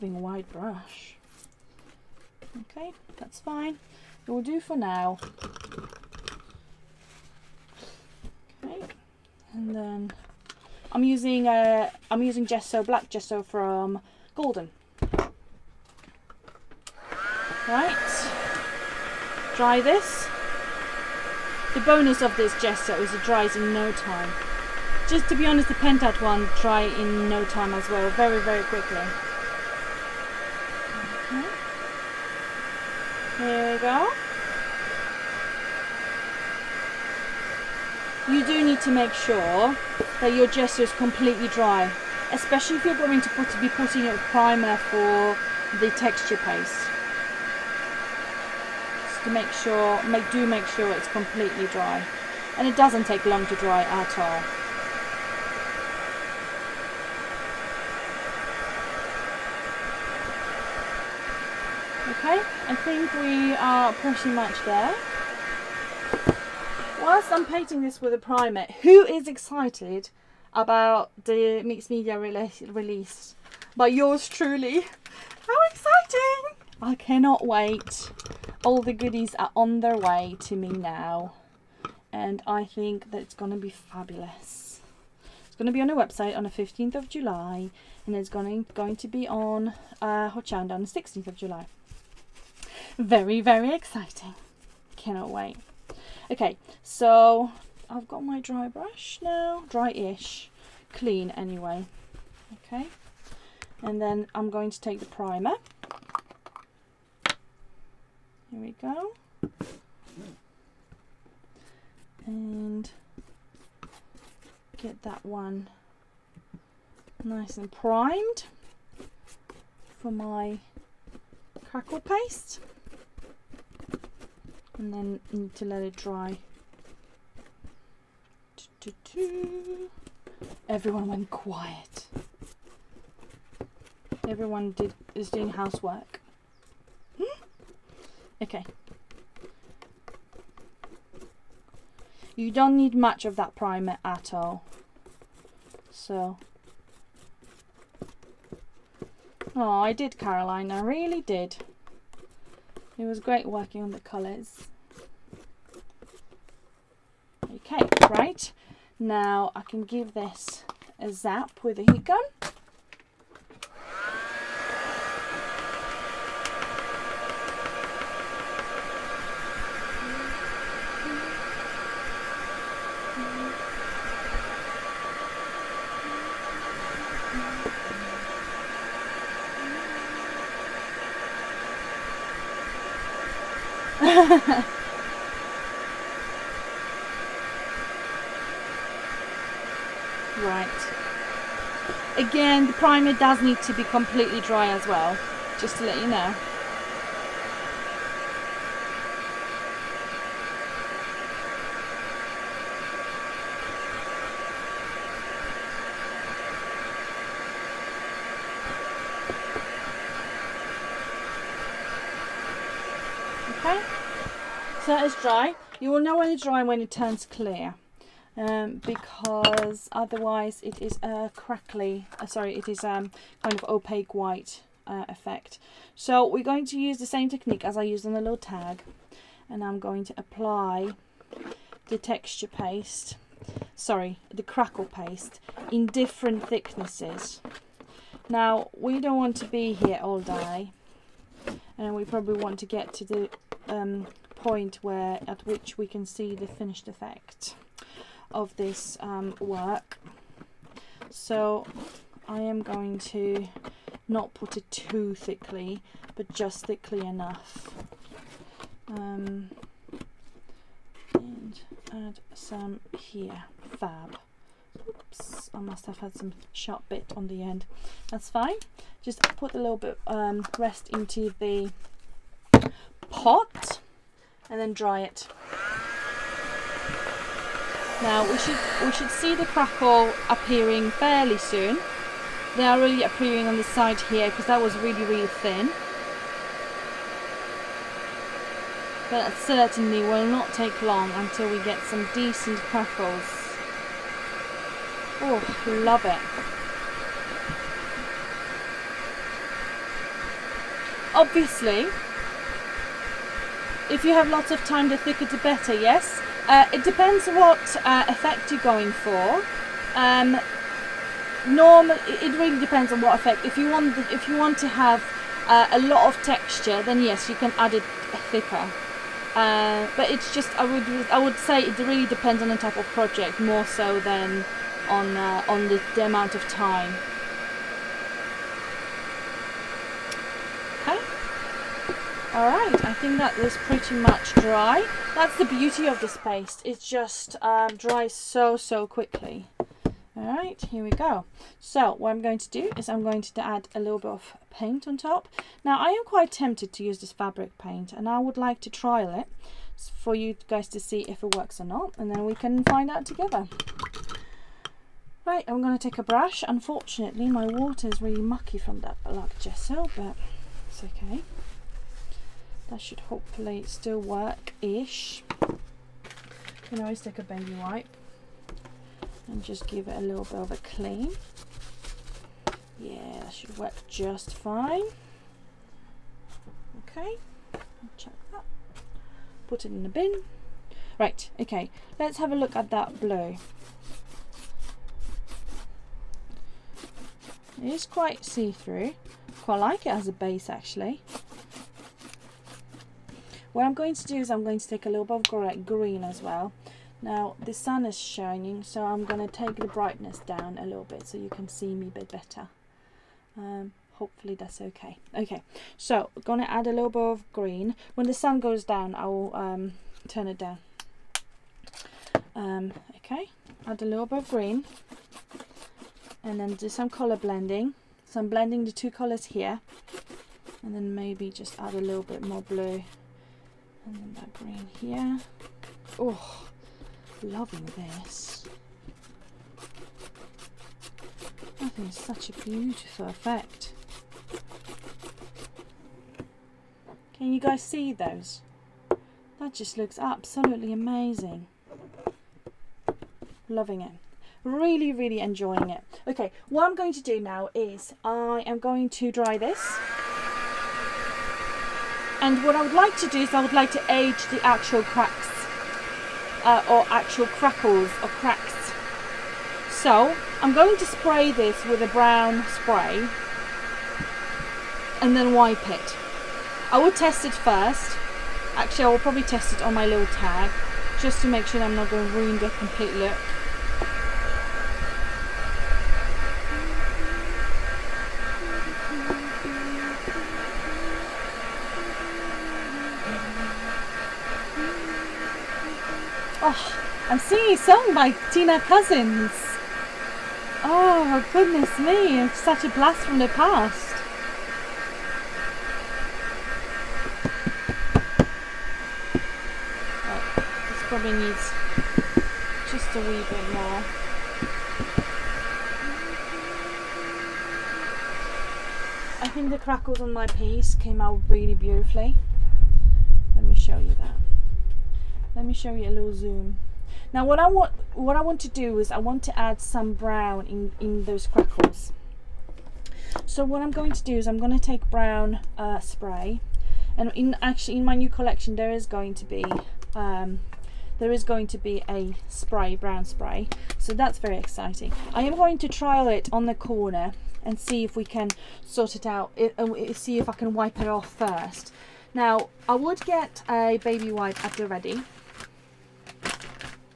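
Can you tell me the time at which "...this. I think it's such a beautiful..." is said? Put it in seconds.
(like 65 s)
427 s.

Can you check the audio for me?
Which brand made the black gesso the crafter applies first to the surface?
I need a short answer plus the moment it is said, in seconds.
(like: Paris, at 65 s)
Golden, at 14 s.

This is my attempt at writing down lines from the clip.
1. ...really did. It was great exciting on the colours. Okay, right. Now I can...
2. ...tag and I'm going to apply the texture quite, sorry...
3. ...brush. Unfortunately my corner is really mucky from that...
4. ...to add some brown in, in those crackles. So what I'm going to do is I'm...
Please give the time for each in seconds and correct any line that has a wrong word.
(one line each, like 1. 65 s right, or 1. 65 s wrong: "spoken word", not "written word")
1. 150 s wrong: "working", not "exciting"
2. 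228 s wrong: "paste", not "quite"
3. 356 s wrong: "water", not "corner"
4. 519 s right.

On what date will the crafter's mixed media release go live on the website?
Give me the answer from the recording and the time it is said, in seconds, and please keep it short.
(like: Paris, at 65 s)
15th of July, at 86 s.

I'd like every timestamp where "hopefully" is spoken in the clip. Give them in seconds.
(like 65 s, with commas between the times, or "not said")
363 s, 403 s.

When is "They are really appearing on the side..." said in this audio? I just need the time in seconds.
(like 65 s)
282 s.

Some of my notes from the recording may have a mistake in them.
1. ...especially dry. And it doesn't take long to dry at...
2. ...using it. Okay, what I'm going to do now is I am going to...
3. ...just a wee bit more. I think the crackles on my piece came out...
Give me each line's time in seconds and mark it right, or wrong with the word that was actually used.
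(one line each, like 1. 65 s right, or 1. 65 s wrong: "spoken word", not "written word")
1. 51 s wrong: "completely", not "especially"
2. 445 s wrong: "enjoying", not "using"
3. 502 s right.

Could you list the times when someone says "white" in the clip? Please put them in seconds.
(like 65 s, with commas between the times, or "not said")
0 s, 224 s.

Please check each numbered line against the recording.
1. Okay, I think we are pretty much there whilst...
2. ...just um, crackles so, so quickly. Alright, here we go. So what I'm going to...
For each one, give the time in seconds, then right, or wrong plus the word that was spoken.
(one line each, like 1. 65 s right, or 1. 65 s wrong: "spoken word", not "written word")
1. 62 s right
2. 336 s wrong: "dries", not "crackles".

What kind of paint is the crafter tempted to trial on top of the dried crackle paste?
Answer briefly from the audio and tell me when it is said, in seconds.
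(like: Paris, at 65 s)
fabric paint, at 347 s.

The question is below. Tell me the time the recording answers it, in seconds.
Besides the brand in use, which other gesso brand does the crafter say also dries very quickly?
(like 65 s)
25 s.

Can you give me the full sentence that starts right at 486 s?
Gosh, I'm singing a song by Tina Cousins.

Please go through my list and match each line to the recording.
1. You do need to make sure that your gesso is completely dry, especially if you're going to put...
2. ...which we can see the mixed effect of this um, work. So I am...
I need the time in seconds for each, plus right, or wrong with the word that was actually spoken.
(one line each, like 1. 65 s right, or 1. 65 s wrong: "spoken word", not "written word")
1. 38 s right
2. 245 s wrong: "finished", not "mixed".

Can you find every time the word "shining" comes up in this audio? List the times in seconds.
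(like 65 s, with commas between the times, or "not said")
397 s.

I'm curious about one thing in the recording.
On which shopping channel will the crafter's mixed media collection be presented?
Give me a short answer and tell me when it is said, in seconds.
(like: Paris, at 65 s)
Hochanda, at 90 s.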